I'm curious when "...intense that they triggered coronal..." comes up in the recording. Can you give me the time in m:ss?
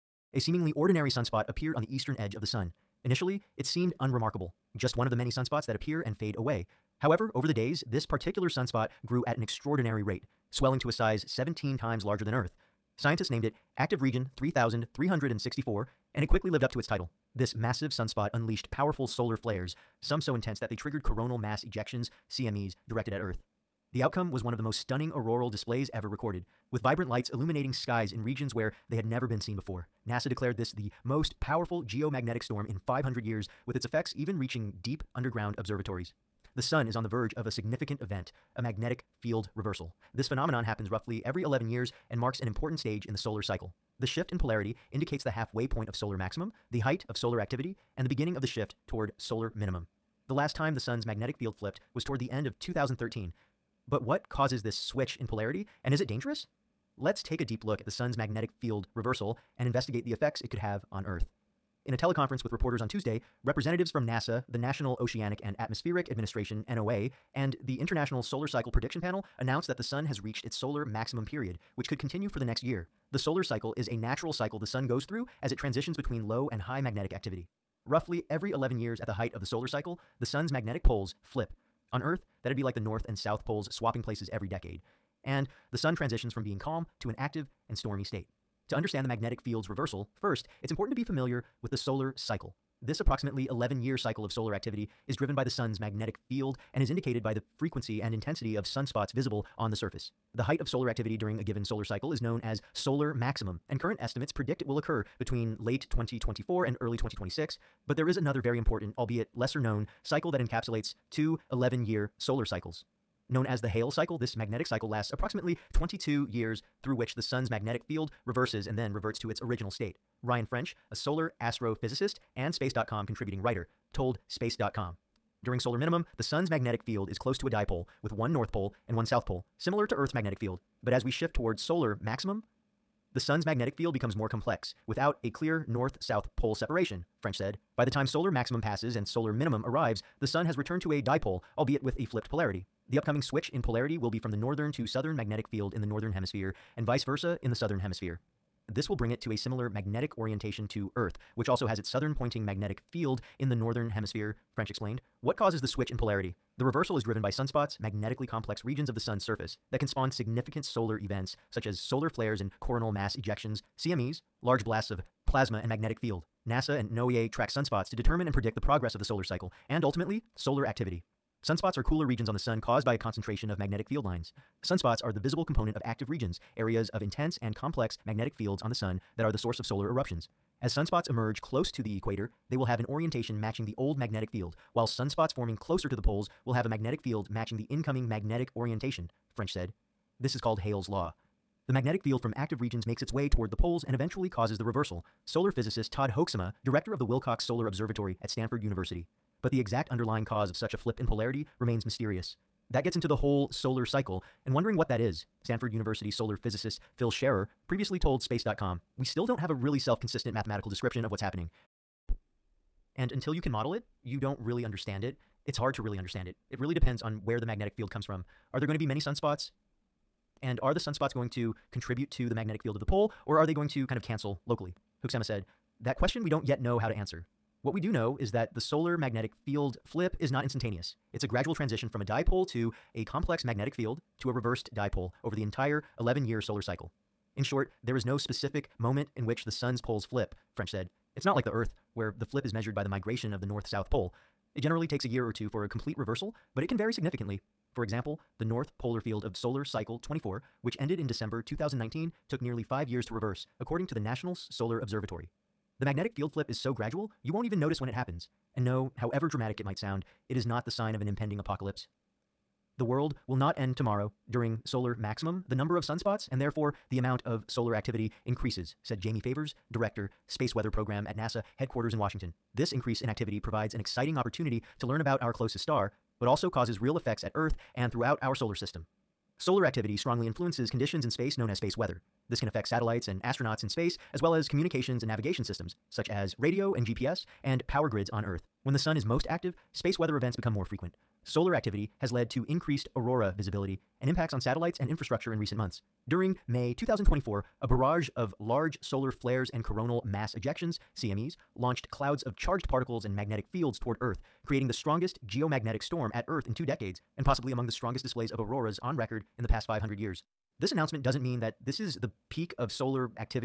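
0:20.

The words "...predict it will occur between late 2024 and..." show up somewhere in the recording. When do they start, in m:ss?
1:44.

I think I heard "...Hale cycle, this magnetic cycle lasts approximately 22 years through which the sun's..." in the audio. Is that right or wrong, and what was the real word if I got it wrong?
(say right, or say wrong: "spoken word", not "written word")
right.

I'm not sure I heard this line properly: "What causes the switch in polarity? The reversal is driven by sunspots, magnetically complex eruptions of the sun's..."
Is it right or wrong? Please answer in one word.
wrong.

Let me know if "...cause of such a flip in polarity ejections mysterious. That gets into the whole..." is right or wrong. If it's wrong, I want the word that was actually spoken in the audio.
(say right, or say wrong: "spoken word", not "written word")
wrong: "remains", not "ejections".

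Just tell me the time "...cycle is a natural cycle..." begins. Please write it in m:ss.
1:13.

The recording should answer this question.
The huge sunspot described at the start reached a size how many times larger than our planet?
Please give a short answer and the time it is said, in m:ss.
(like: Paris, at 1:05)
17, at 0:11.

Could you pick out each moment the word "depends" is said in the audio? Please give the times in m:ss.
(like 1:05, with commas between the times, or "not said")
3:36.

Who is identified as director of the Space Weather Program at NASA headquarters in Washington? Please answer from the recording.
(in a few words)
Jamie Favors.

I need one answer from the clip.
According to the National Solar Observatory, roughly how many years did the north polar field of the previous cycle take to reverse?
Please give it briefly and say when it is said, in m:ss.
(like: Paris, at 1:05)
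5, at 4:12.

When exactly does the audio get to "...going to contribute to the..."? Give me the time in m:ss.
3:41.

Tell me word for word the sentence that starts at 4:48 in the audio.
When the sun is most active, space weather events become more frequent.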